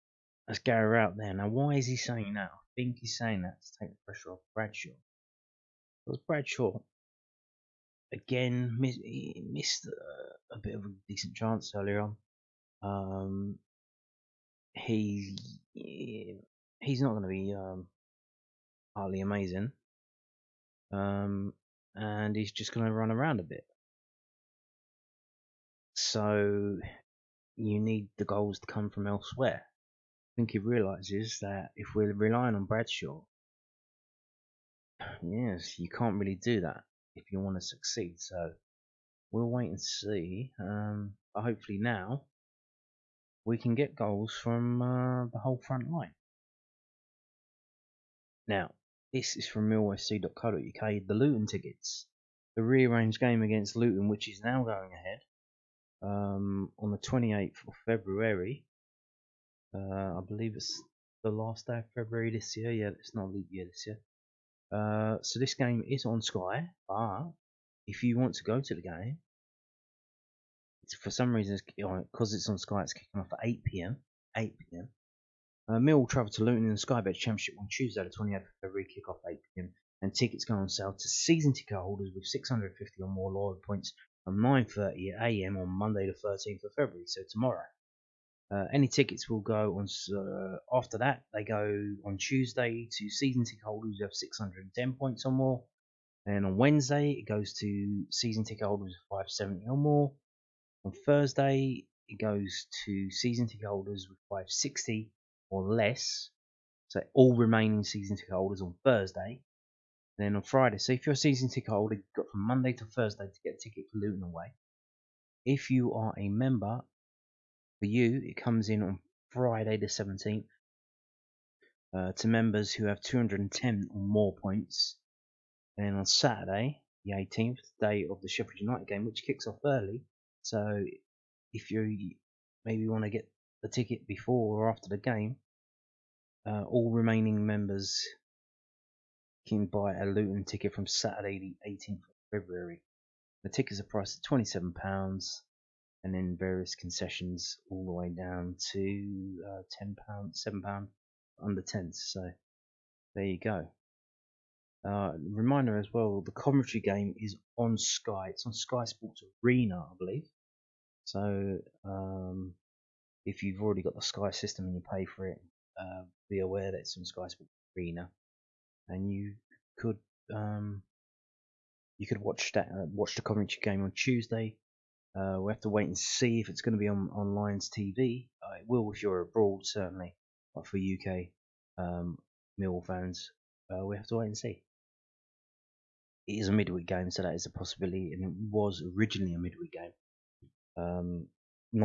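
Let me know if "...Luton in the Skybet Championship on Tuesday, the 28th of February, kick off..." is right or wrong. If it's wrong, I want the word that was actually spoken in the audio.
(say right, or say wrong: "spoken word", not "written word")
right.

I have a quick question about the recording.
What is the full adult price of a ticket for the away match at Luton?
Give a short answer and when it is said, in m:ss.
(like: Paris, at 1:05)
£27, at 2:24.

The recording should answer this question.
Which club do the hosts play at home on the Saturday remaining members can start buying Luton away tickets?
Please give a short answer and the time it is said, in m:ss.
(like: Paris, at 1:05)
Sheffield United, at 2:08.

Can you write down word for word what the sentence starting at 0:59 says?
Uh, I believe it's the last day of February this year.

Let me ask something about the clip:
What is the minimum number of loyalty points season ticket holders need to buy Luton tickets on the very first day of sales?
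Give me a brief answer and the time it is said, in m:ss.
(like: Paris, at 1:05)
650, at 1:22.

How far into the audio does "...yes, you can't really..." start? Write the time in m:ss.
0:35.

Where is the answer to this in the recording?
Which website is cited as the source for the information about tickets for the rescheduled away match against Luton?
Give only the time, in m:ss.
0:49.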